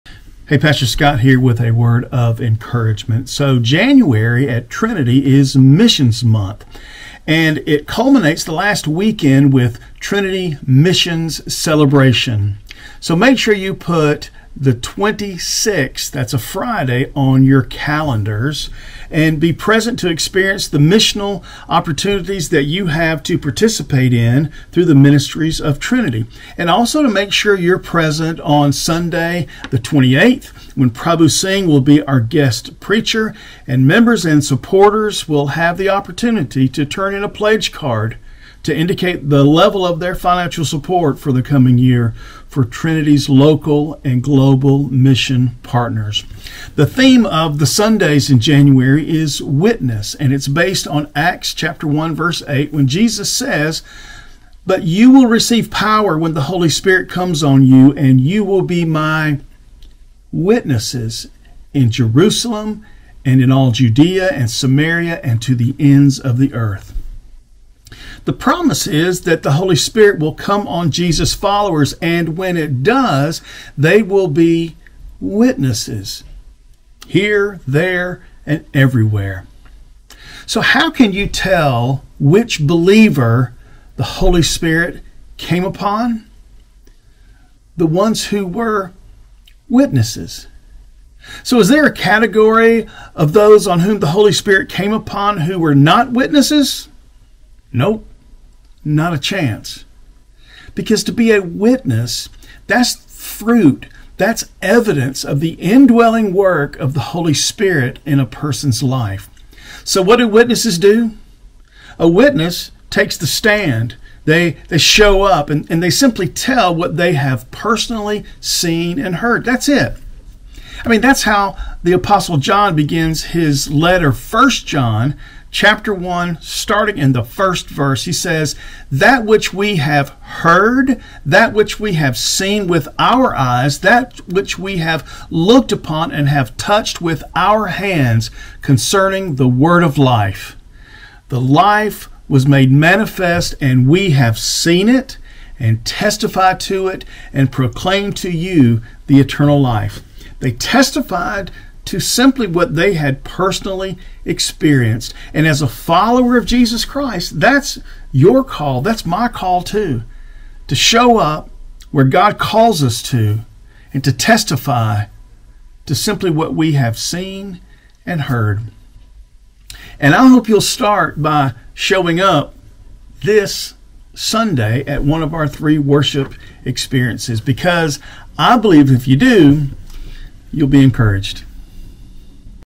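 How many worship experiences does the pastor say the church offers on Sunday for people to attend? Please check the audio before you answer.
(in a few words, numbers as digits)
3.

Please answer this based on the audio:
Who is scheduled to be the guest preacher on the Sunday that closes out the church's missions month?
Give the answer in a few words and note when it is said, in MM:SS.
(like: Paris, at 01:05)
Prabhu Singh, at 00:30.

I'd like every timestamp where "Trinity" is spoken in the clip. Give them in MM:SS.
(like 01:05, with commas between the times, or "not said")
00:04, 00:10, 00:25, 00:42.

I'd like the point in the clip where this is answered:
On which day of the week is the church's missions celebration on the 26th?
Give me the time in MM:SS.
00:16.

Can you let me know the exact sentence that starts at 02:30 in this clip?
They testified to simply what they had personally experienced.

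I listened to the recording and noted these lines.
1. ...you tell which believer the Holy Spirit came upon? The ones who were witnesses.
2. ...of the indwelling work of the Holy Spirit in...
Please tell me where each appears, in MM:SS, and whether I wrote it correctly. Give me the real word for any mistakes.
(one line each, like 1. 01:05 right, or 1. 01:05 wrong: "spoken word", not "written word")
1. 01:21 right
2. 01:45 right.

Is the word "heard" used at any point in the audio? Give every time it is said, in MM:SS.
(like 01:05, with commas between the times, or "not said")
01:59, 02:10, 02:48.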